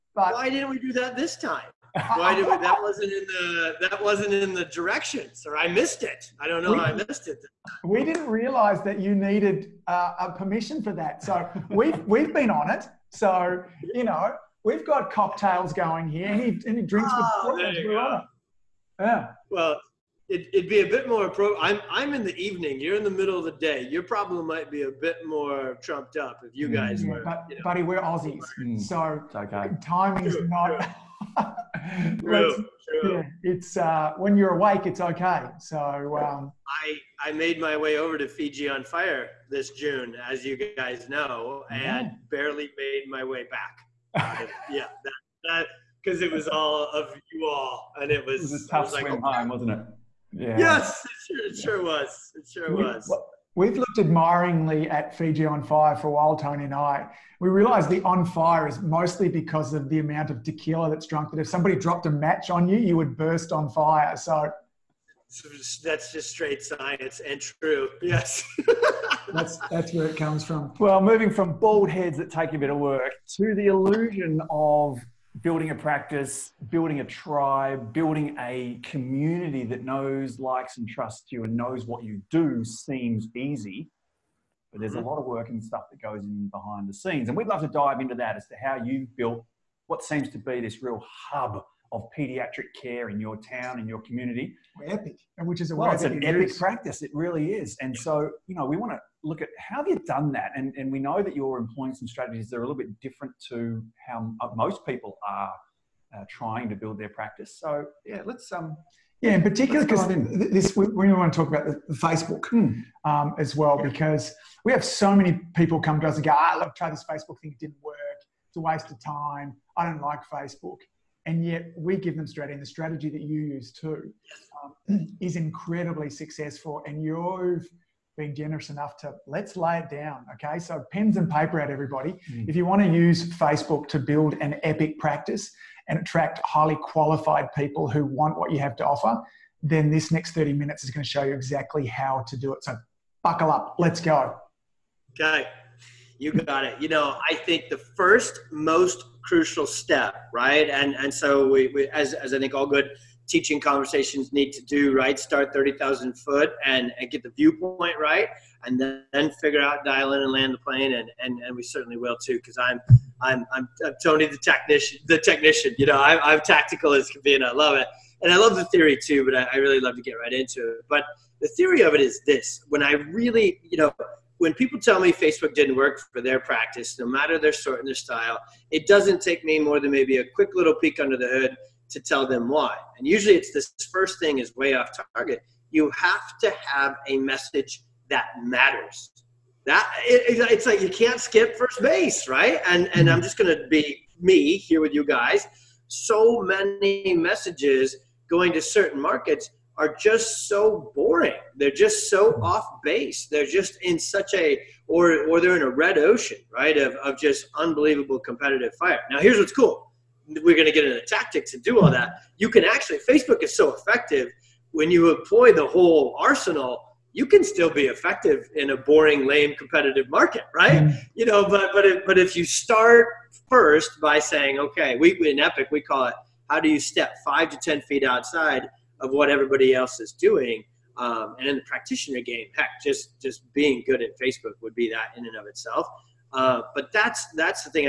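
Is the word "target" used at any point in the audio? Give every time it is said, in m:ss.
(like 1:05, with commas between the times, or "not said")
3:05.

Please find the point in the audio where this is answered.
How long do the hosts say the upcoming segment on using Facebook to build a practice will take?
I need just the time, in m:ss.
2:20.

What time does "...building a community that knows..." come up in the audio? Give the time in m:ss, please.
1:17.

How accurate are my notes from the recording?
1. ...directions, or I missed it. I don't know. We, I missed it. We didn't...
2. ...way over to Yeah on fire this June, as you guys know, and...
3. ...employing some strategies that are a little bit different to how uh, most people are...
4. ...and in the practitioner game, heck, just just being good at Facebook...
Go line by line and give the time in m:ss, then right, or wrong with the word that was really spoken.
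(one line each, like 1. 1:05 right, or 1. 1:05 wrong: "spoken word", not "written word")
1. 0:04 right
2. 0:37 wrong: "Fiji", not "Yeah"
3. 1:41 right
4. 3:51 right.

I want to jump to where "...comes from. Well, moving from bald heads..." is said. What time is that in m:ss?
1:10.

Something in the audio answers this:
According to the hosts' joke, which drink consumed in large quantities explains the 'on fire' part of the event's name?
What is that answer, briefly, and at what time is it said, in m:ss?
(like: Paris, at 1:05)
tequila, at 1:00.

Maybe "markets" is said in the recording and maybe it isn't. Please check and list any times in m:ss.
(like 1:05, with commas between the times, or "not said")
3:19, 3:40.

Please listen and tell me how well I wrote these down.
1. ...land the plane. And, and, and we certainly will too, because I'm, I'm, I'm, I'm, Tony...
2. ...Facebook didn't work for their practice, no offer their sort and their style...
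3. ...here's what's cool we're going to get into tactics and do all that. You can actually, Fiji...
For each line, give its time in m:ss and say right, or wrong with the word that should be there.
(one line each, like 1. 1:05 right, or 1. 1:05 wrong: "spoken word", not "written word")
1. 2:40 right
2. 2:55 wrong: "matter", not "offer"
3. 3:29 wrong: "Facebook", not "Fiji".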